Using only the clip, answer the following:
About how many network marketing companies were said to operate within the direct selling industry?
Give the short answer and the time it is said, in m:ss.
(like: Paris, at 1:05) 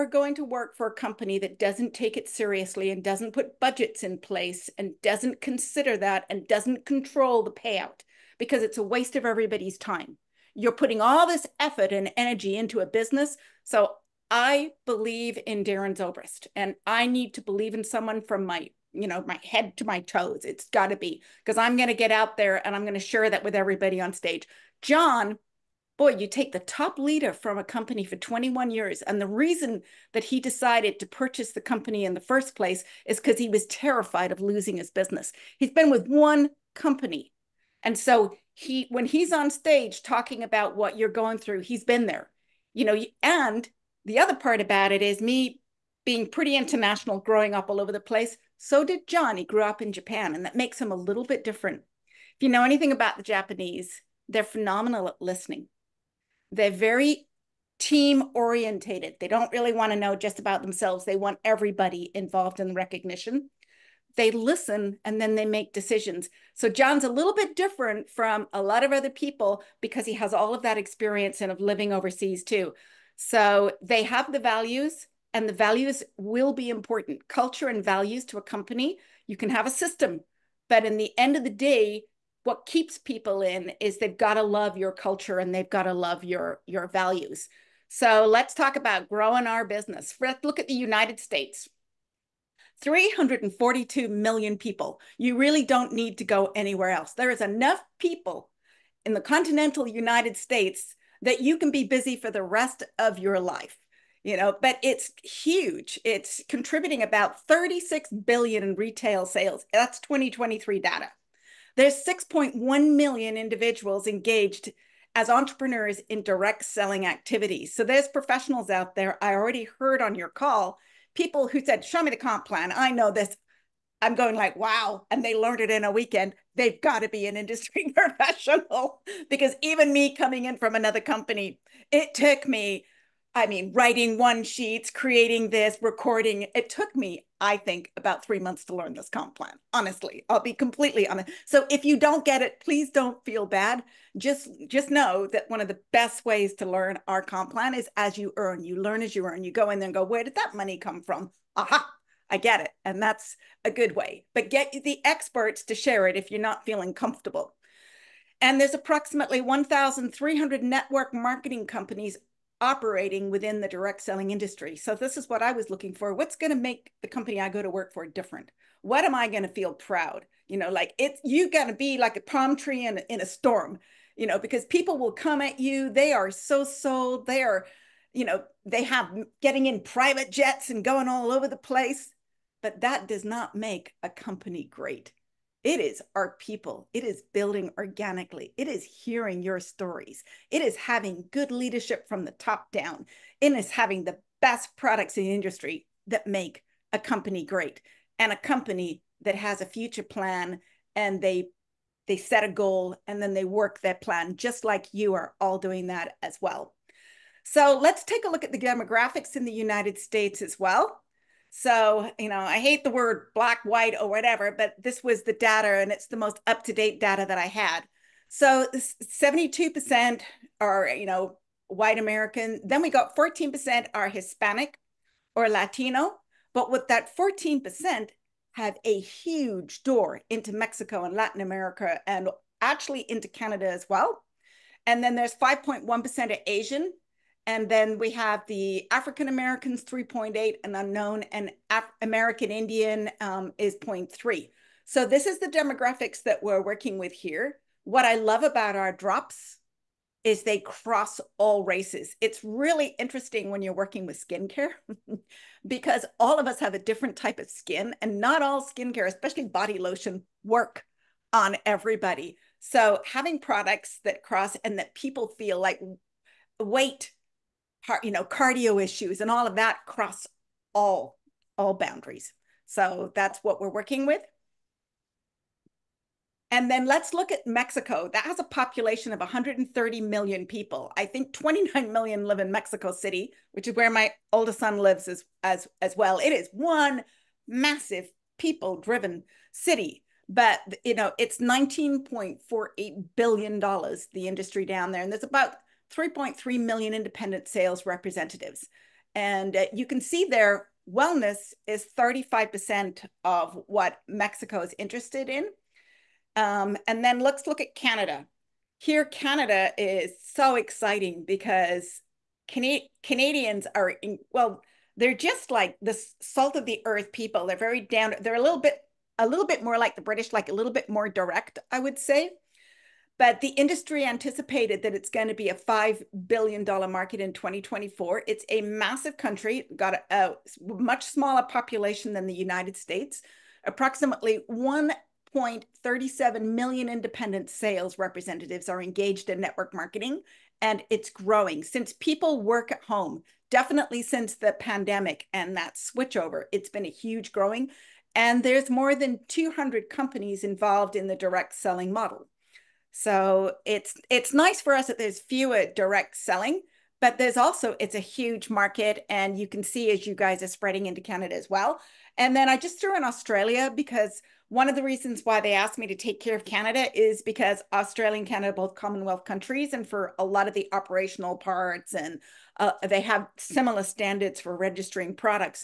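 1,300, at 2:39.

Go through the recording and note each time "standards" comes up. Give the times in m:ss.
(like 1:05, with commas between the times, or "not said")
6:13.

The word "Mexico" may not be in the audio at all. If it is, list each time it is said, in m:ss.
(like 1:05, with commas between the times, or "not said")
3:50, 4:37, 4:42, 5:04.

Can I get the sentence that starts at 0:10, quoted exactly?
You're putting all this effort and energy into a business.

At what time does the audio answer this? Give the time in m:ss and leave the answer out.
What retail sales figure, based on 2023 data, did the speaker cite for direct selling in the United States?
1:47.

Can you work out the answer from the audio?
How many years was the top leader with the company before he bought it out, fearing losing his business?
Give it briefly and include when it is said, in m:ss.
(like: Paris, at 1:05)
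21 years, at 0:28.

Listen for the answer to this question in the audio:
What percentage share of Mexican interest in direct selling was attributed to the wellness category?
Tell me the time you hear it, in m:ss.
5:01.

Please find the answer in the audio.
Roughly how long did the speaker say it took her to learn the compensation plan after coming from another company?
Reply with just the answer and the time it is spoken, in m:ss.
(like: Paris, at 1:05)
About three months, at 2:17.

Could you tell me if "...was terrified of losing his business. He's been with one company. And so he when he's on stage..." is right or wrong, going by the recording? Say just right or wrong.
right.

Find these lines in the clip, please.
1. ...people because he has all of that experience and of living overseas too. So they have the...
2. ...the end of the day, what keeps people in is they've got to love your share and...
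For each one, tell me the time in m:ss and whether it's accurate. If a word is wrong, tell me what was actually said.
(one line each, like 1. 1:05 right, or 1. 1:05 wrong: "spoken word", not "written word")
1. 1:09 right
2. 1:20 wrong: "culture", not "share".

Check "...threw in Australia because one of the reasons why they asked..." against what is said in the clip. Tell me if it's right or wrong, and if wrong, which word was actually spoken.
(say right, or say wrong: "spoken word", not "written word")
right.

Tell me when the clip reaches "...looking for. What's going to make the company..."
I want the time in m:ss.
2:45.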